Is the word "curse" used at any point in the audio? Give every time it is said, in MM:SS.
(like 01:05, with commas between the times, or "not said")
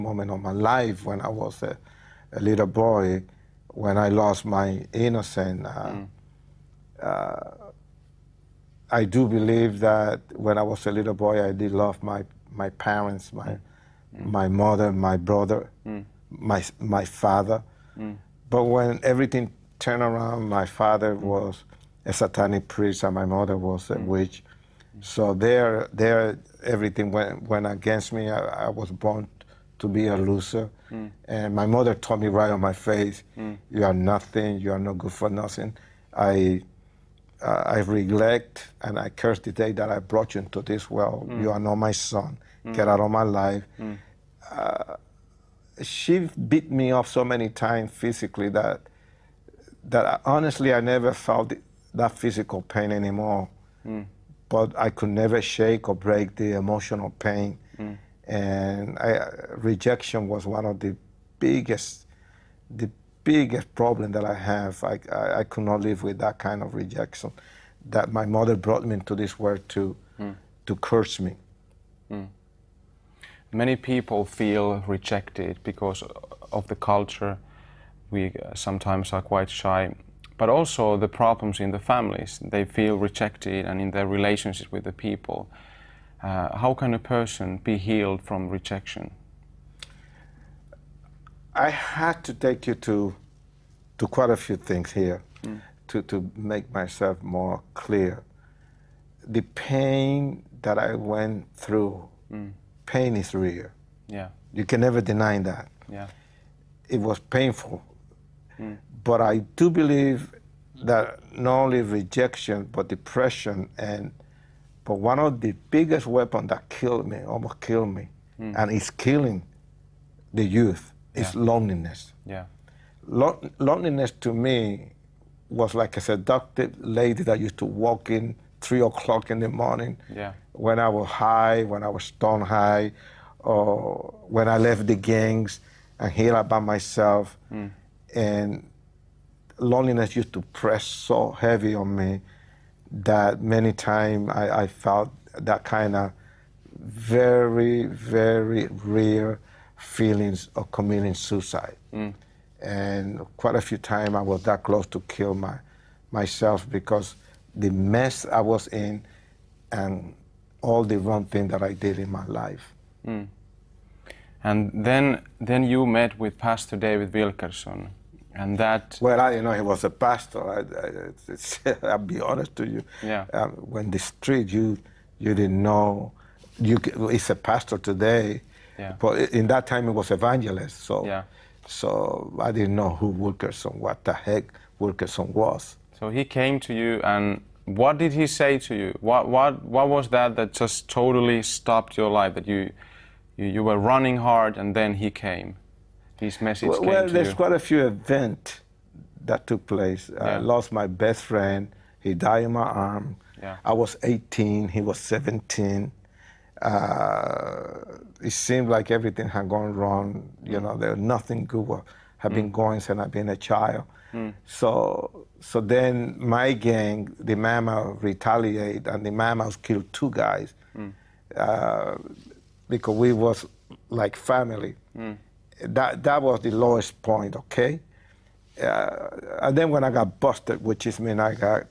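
00:39, 01:10.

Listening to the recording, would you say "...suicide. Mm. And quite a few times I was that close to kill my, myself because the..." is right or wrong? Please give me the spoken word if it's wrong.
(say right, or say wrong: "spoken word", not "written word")
right.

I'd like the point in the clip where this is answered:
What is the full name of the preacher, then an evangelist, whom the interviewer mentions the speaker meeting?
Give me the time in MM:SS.
02:46.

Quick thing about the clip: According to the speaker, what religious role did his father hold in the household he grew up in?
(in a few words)
Satanic priest.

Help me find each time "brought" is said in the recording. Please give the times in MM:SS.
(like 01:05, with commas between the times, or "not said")
00:39, 01:08.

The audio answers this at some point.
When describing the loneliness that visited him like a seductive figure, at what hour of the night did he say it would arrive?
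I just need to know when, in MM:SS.
02:08.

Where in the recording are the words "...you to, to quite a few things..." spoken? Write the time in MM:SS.
01:32.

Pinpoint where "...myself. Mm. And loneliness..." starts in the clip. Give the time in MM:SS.
02:16.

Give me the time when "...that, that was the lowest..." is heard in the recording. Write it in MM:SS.
03:45.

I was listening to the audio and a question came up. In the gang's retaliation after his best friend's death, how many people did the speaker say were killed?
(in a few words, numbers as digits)
2.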